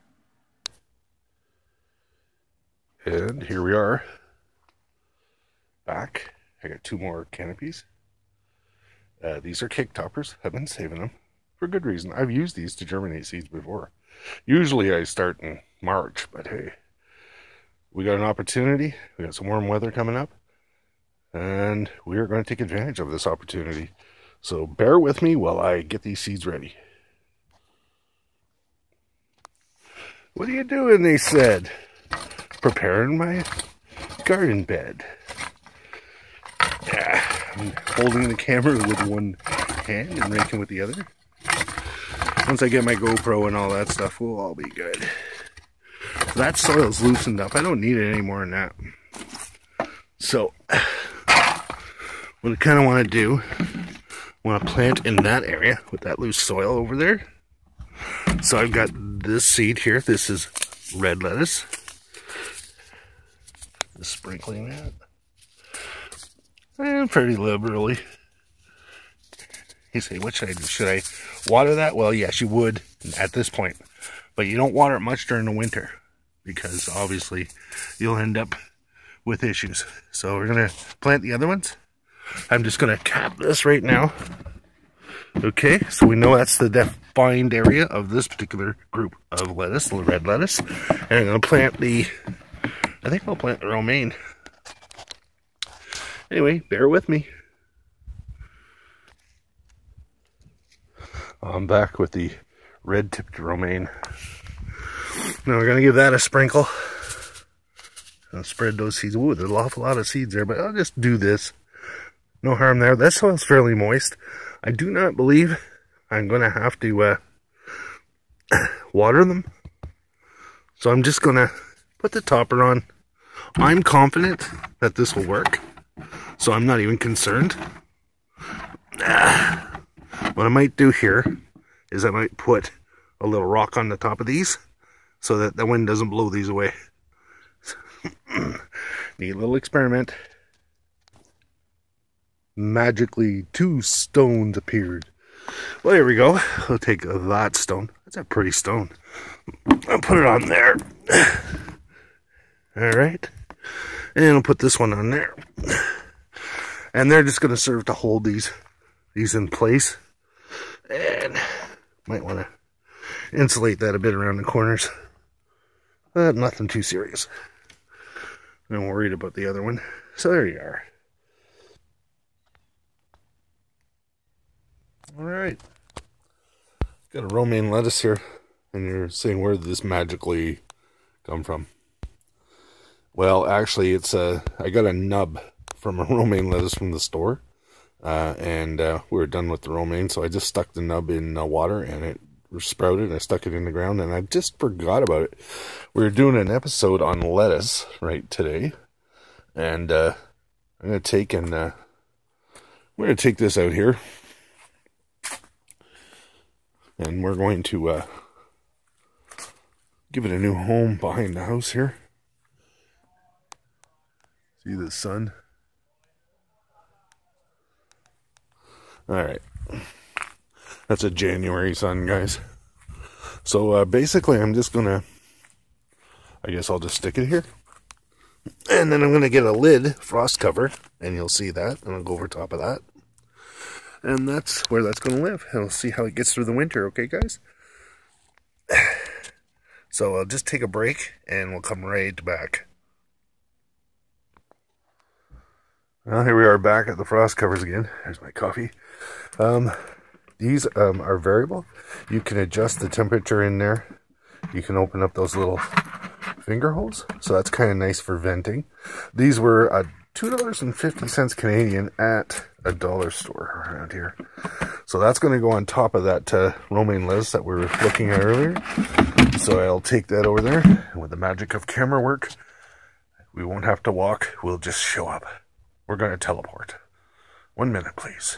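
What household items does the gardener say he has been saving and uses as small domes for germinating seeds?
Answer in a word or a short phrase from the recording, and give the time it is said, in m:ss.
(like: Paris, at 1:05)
Cake toppers, at 0:09.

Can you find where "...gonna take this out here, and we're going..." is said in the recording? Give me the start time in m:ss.
3:23.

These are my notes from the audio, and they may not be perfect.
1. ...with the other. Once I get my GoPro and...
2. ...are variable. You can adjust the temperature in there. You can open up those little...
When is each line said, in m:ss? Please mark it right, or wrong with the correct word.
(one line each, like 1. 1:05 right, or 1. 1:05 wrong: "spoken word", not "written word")
1. 0:40 right
2. 4:11 right.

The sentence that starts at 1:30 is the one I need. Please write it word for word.
And I'm going to plant the, I think I'll plant the romaine.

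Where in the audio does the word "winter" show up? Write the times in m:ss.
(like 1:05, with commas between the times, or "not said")
1:15, 3:56.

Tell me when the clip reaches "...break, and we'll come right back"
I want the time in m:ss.
4:00.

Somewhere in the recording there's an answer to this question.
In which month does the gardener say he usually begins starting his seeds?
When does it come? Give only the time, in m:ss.
0:15.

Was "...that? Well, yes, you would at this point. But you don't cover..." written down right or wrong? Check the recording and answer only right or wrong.
wrong.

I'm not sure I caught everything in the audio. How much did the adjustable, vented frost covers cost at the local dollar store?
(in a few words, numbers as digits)
$2.50 Canadian.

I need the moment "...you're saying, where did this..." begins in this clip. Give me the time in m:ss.
2:58.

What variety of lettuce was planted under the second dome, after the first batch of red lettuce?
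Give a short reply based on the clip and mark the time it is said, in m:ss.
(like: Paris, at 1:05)
Red-tipped romaine, at 1:42.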